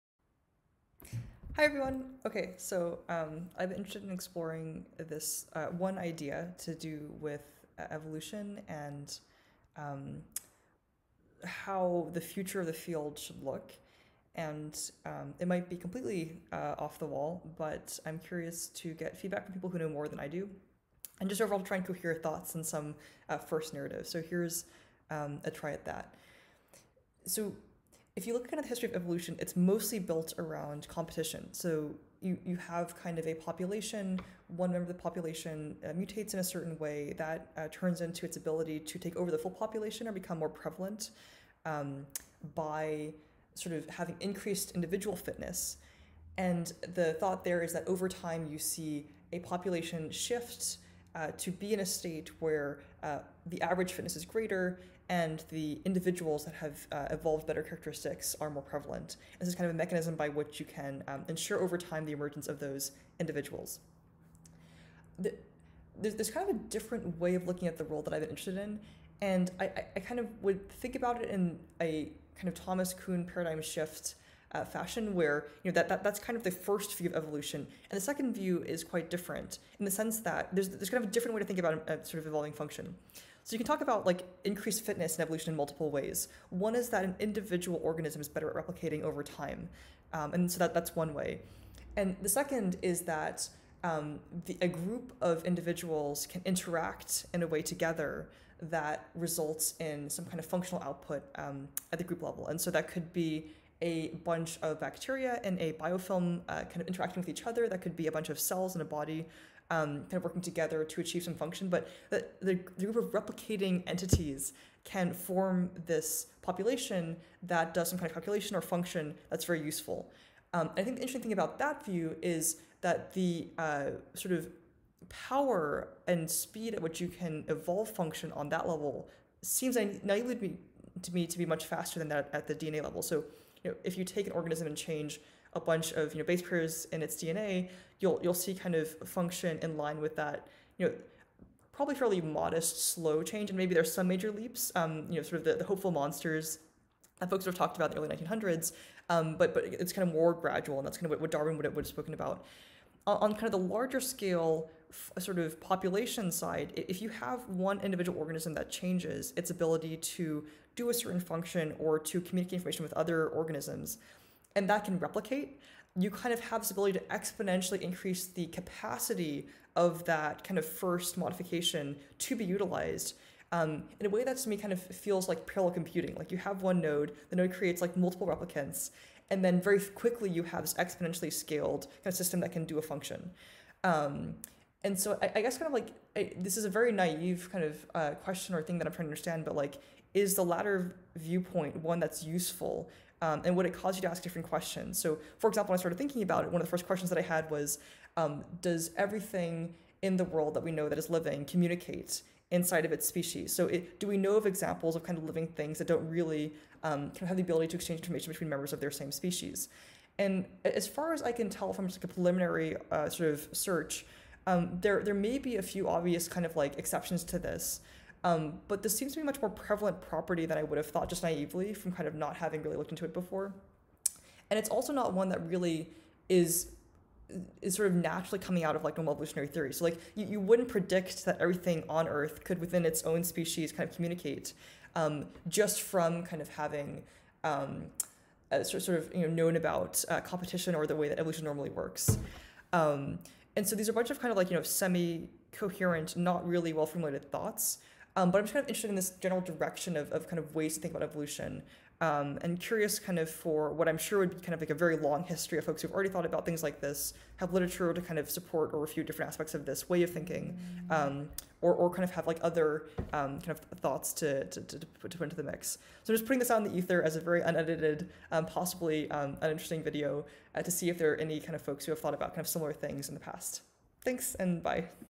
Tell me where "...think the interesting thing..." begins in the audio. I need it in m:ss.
2:00.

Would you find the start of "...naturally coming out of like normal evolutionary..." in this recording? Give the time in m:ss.
3:47.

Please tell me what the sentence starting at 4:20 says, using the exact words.
um, or, or kind of have like other um, kind of thoughts to, to, to, put, to put into the mix.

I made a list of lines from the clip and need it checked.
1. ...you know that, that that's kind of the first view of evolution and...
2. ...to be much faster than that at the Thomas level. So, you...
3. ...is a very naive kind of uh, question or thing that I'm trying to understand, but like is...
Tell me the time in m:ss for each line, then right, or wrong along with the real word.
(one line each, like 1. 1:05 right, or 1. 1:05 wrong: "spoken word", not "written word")
1. 1:15 right
2. 2:11 wrong: "DNA", not "Thomas"
3. 3:06 right.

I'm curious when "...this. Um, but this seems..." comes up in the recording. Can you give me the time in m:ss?
3:37.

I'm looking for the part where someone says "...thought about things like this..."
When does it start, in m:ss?
4:16.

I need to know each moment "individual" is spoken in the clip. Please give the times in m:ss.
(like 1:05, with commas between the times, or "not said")
0:44, 0:55, 1:03, 1:27, 1:35, 2:37.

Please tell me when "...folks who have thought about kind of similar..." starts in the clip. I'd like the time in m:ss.
4:31.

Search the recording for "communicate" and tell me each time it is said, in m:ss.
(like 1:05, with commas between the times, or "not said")
2:42, 3:21, 3:53.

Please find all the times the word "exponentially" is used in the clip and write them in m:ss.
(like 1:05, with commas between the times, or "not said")
2:47, 3:00.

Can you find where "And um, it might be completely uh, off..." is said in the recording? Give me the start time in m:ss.
0:14.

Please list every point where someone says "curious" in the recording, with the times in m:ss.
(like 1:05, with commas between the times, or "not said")
0:18, 4:12.